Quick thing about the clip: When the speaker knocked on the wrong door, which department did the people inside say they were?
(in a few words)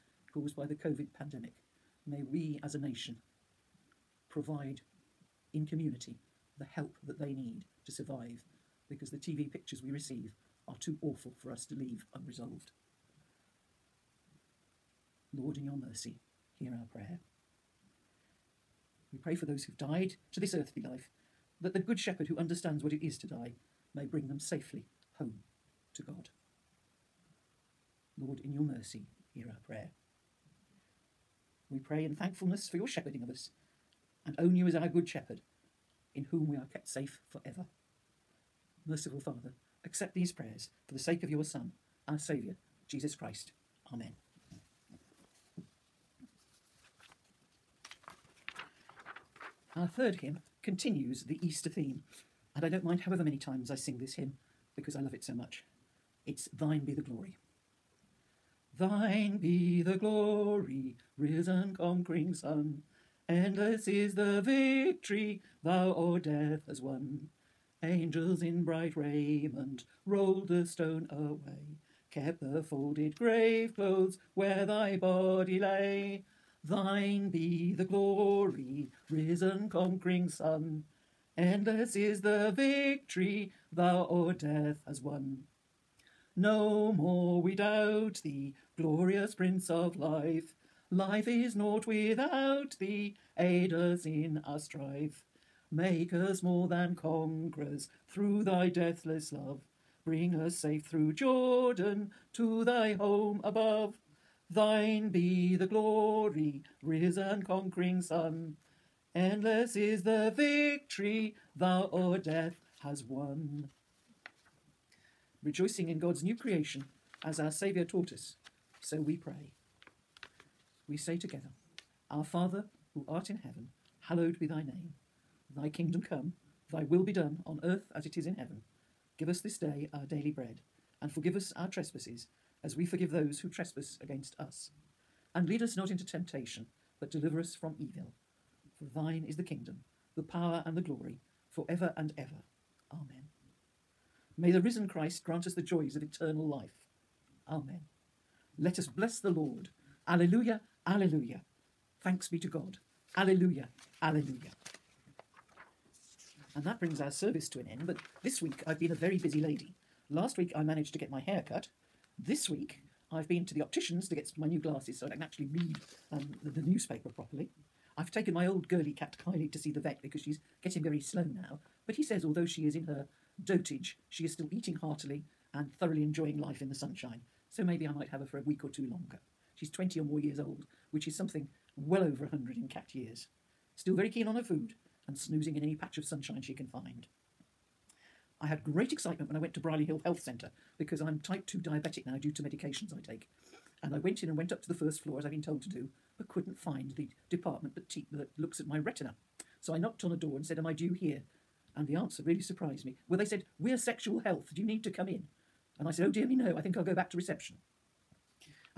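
Sexual health.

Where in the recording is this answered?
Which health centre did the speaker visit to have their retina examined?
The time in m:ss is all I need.
3:09.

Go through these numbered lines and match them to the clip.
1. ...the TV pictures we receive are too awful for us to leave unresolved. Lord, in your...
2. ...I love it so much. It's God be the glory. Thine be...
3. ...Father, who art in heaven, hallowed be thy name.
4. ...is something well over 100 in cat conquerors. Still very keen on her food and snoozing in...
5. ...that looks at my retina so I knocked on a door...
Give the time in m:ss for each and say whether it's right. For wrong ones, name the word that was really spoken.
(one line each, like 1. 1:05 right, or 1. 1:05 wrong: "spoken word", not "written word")
1. 0:09 right
2. 0:54 wrong: "Thine", not "God"
3. 2:02 right
4. 3:01 wrong: "years", not "conquerors"
5. 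3:18 right.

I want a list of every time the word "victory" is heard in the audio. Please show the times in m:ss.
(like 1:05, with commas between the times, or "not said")
1:04, 1:22, 1:50.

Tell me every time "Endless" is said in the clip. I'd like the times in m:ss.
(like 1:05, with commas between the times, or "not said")
1:03, 1:21, 1:49.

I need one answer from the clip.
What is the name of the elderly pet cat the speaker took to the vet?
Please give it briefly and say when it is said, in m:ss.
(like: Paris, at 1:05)
Kylie, at 2:49.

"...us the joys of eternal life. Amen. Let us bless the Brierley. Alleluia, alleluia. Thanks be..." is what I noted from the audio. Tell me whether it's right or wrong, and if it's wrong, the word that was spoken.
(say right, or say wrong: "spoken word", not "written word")
wrong: "Lord", not "Brierley".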